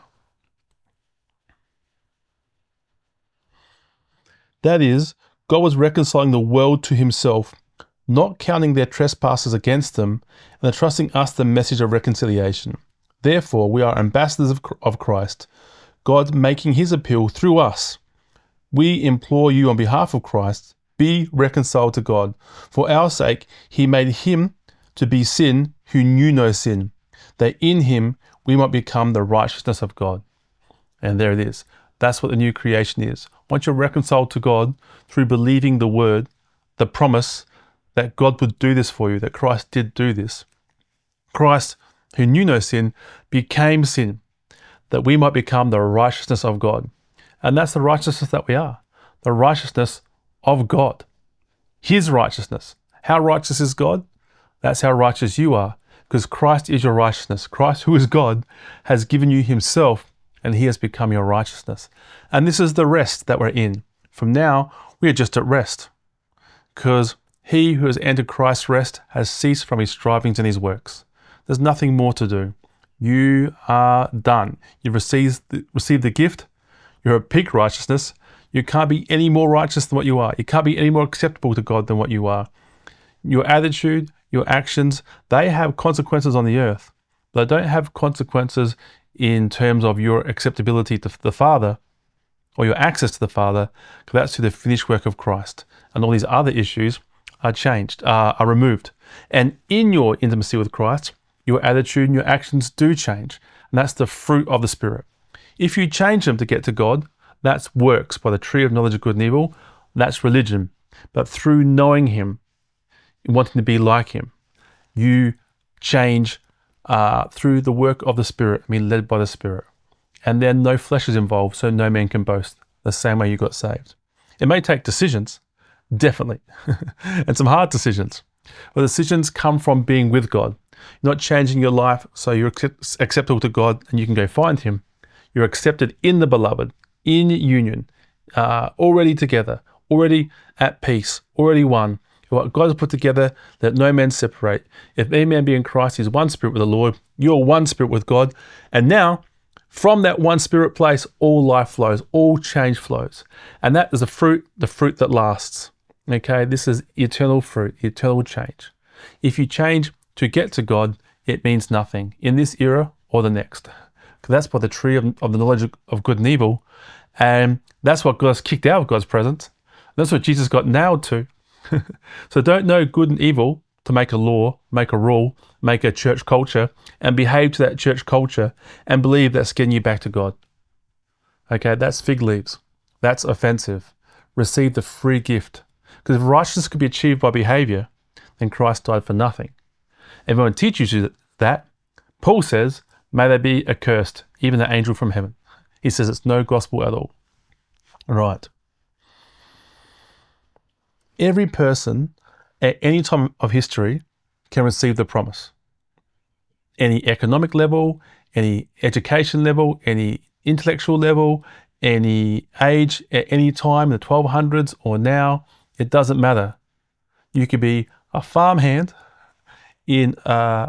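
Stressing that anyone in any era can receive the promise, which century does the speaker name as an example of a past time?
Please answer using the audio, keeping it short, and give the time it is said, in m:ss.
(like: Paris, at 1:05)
the 1200s, at 3:33.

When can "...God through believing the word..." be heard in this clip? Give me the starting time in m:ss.
0:34.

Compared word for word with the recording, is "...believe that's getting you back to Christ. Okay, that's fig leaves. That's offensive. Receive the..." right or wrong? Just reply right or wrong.
wrong.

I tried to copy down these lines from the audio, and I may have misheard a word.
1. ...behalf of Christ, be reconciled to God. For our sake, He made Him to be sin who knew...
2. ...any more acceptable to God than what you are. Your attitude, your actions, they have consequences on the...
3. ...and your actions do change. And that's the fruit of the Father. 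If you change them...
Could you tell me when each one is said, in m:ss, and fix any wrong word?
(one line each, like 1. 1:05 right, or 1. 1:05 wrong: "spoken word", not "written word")
1. 0:19 right
2. 1:20 right
3. 1:42 wrong: "Spirit", not "Father".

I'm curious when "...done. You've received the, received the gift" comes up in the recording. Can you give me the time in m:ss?
1:14.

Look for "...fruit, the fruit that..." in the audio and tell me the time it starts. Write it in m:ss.
2:34.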